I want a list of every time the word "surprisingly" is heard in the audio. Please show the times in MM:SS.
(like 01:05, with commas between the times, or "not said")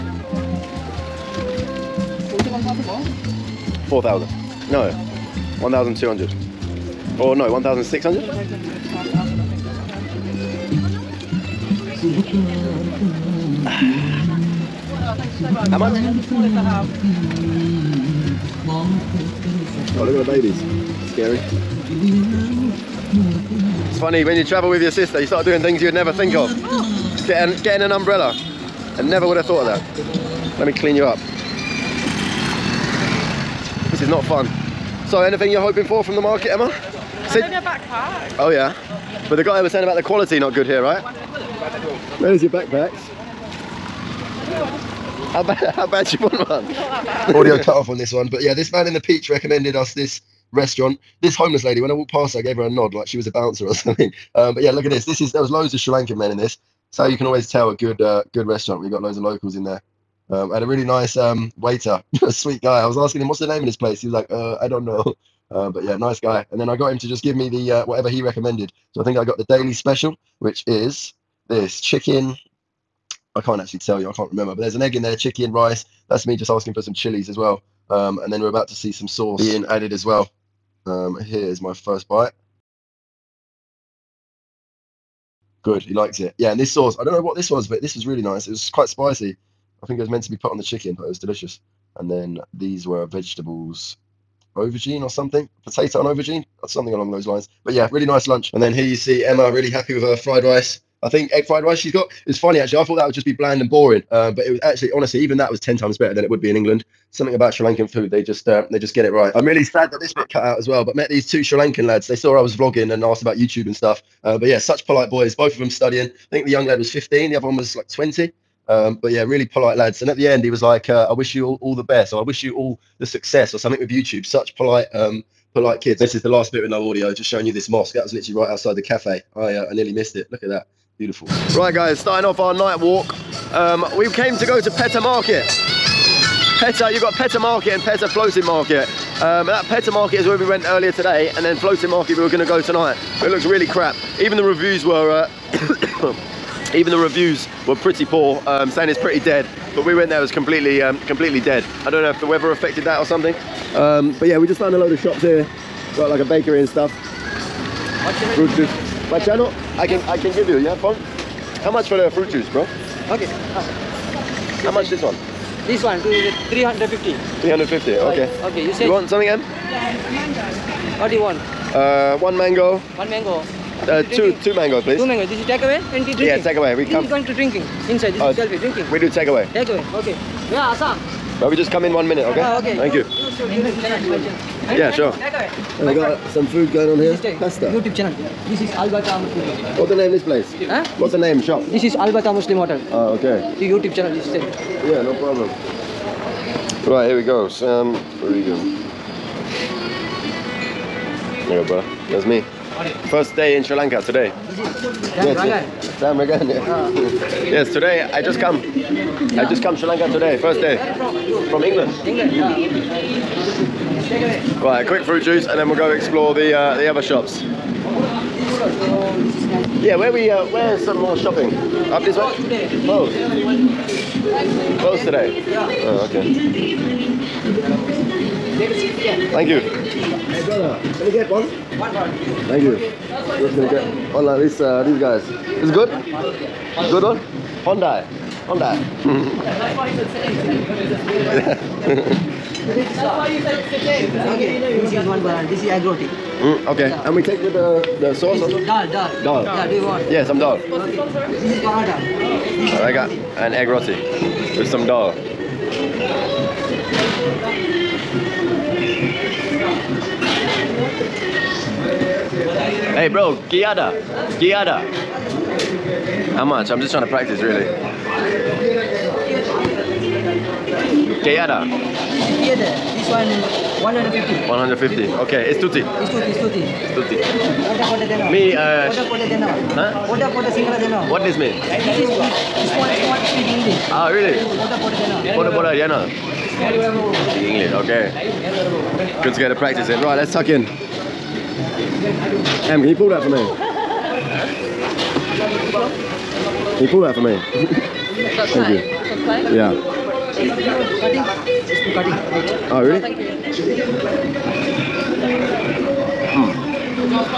not said.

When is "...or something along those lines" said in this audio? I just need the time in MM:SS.
01:36.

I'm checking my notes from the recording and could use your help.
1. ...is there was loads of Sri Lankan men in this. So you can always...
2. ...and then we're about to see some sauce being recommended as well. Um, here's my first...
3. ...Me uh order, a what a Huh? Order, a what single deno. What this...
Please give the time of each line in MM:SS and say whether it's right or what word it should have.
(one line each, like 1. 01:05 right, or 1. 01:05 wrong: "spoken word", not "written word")
1. 00:55 right
2. 01:18 wrong: "added", not "recommended"
3. 04:38 right.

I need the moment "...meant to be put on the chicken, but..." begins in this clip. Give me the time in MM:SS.
01:30.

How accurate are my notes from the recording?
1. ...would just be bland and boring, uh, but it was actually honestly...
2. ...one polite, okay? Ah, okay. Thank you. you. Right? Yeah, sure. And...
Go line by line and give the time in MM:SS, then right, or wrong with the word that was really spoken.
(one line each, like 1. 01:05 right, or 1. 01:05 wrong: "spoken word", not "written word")
1. 01:43 right
2. 03:01 wrong: "minute", not "polite".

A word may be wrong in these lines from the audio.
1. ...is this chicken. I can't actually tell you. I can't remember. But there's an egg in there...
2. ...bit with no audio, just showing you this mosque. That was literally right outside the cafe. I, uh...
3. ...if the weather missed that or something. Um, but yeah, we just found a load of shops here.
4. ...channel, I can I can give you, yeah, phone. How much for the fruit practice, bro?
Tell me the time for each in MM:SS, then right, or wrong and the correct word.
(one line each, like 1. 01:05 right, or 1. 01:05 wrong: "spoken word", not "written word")
1. 01:10 right
2. 02:06 right
3. 02:32 wrong: "affected", not "missed"
4. 02:39 wrong: "juice", not "practice".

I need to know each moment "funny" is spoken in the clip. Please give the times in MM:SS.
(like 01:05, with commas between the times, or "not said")
00:23, 01:42.